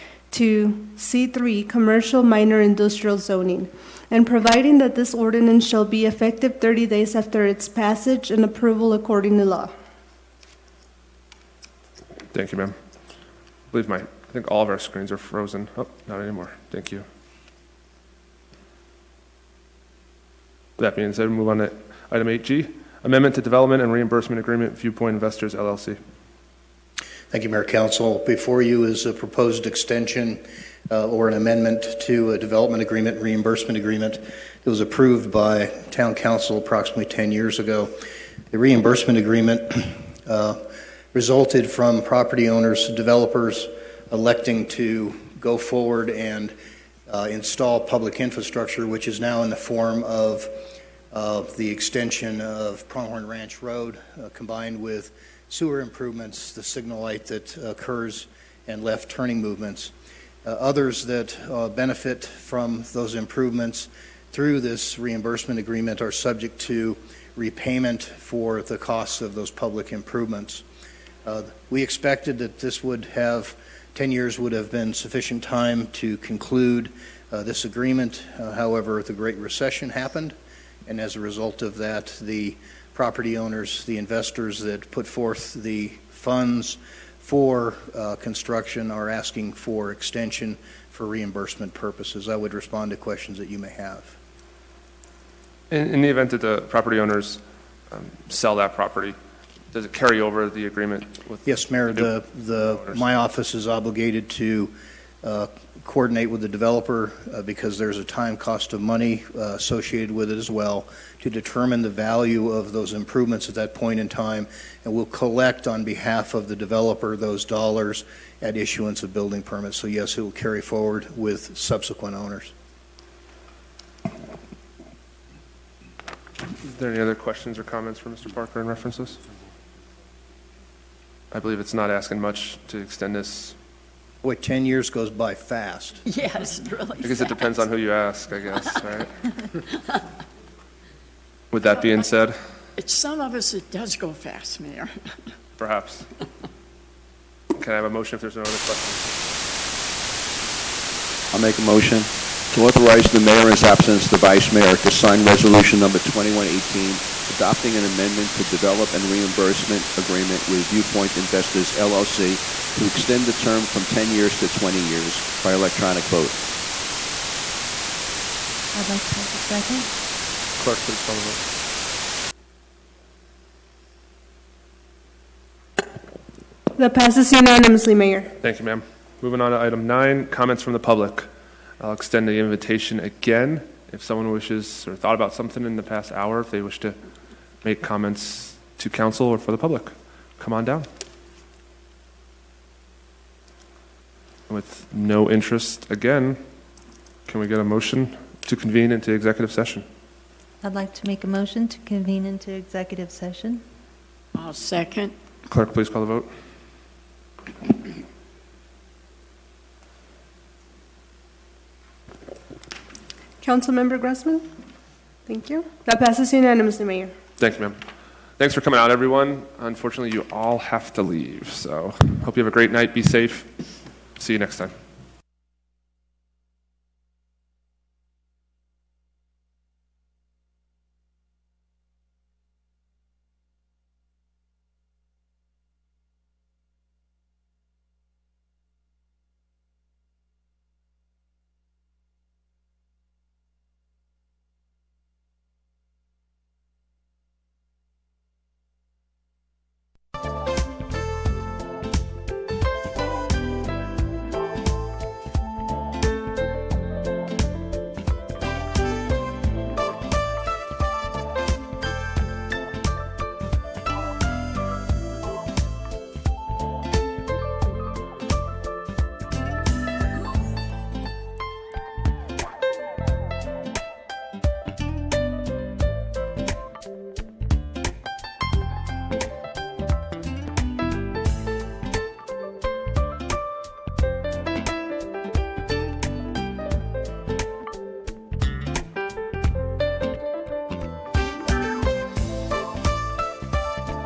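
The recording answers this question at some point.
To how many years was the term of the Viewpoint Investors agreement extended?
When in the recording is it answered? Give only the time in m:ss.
2:44.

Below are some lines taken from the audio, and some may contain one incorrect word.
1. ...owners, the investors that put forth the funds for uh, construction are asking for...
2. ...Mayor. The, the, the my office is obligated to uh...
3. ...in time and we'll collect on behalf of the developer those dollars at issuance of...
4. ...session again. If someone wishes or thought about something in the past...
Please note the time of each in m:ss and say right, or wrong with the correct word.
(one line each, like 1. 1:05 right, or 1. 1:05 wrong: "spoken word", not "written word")
1. 1:23 right
2. 1:41 right
3. 1:53 right
4. 3:02 wrong: "invitation", not "session".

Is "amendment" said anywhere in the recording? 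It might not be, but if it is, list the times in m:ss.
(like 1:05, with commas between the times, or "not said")
0:23, 0:31, 2:37.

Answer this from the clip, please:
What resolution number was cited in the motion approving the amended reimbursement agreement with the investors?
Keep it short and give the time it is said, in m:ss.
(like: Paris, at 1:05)
2118, at 2:35.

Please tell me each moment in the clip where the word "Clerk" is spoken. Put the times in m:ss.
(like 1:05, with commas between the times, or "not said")
2:50, 3:25.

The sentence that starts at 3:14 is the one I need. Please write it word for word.
With no interest again, can we get a motion to convene into executive session?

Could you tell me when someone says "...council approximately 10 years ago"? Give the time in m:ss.
0:36.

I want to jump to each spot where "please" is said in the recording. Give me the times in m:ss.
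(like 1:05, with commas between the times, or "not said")
2:28, 2:50, 3:25.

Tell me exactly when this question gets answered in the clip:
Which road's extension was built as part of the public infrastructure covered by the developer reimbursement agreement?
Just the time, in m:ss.
0:52.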